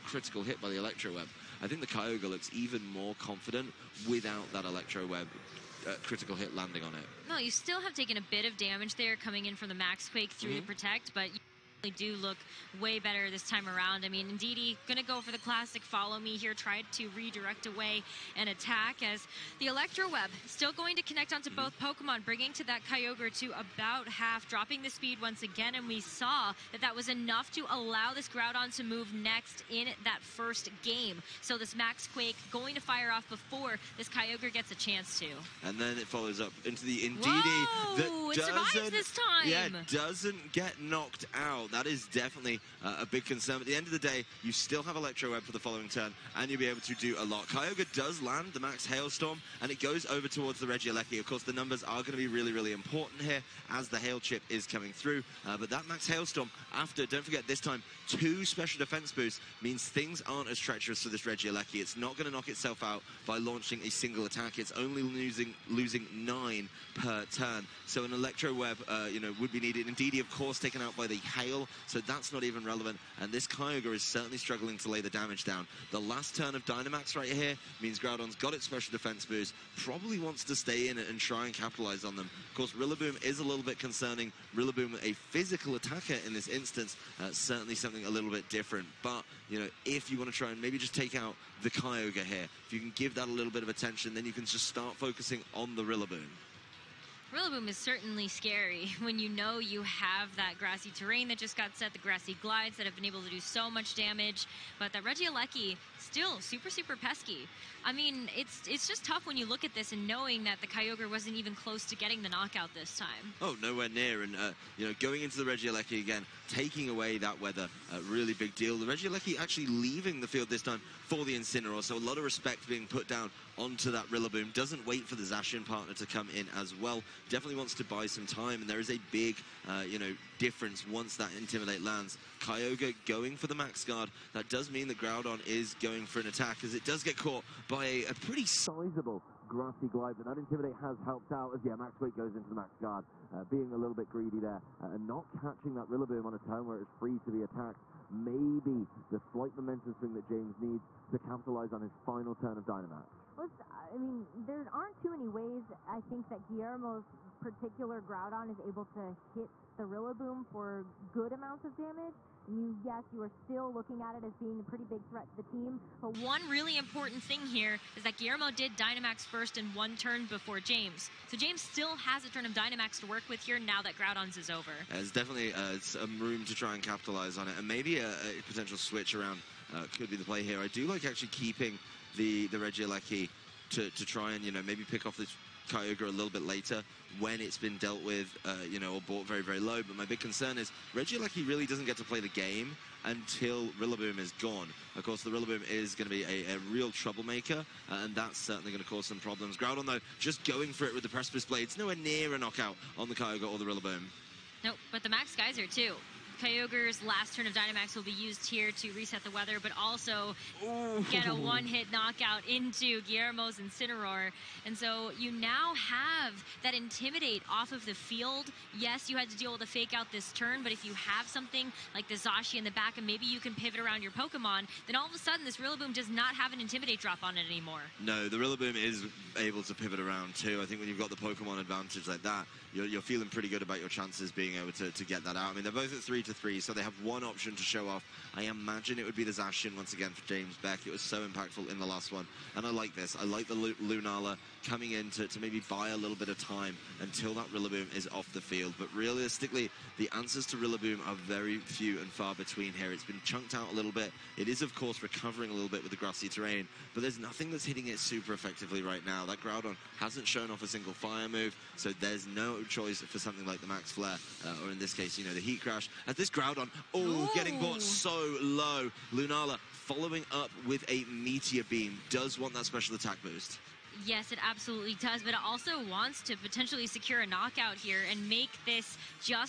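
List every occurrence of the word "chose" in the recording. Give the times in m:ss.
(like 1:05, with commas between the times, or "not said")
not said.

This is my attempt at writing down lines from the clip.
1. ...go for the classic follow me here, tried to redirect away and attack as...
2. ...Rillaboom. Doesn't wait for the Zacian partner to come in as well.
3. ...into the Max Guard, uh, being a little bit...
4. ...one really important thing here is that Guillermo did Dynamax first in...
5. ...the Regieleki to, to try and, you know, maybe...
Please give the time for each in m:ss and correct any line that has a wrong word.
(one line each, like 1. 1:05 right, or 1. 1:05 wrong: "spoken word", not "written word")
1. 0:15 right
2. 2:04 right
3. 2:22 right
4. 2:46 right
5. 3:02 right.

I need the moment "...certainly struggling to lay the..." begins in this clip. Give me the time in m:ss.
1:14.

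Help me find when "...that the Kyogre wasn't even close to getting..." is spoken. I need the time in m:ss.
1:50.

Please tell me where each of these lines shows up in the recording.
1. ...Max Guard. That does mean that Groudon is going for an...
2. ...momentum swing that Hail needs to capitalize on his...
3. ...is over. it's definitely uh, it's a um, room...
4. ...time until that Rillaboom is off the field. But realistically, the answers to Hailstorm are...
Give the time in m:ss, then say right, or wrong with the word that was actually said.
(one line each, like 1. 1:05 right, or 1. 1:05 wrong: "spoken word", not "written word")
1. 2:13 right
2. 2:29 wrong: "James", not "Hail"
3. 2:54 right
4. 4:06 wrong: "Rillaboom", not "Hailstorm".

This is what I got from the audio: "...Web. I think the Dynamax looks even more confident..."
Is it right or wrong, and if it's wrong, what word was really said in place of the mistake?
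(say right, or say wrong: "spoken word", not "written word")
wrong: "Kyogre", not "Dynamax".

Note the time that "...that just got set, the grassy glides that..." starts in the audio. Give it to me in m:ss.
1:41.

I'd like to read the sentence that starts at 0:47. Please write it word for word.
Kyogre does land the Max Hailstorm, and it goes over towards the Regieleki.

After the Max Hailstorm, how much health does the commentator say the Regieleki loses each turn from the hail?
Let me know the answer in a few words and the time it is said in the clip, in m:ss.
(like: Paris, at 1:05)
9, at 1:06.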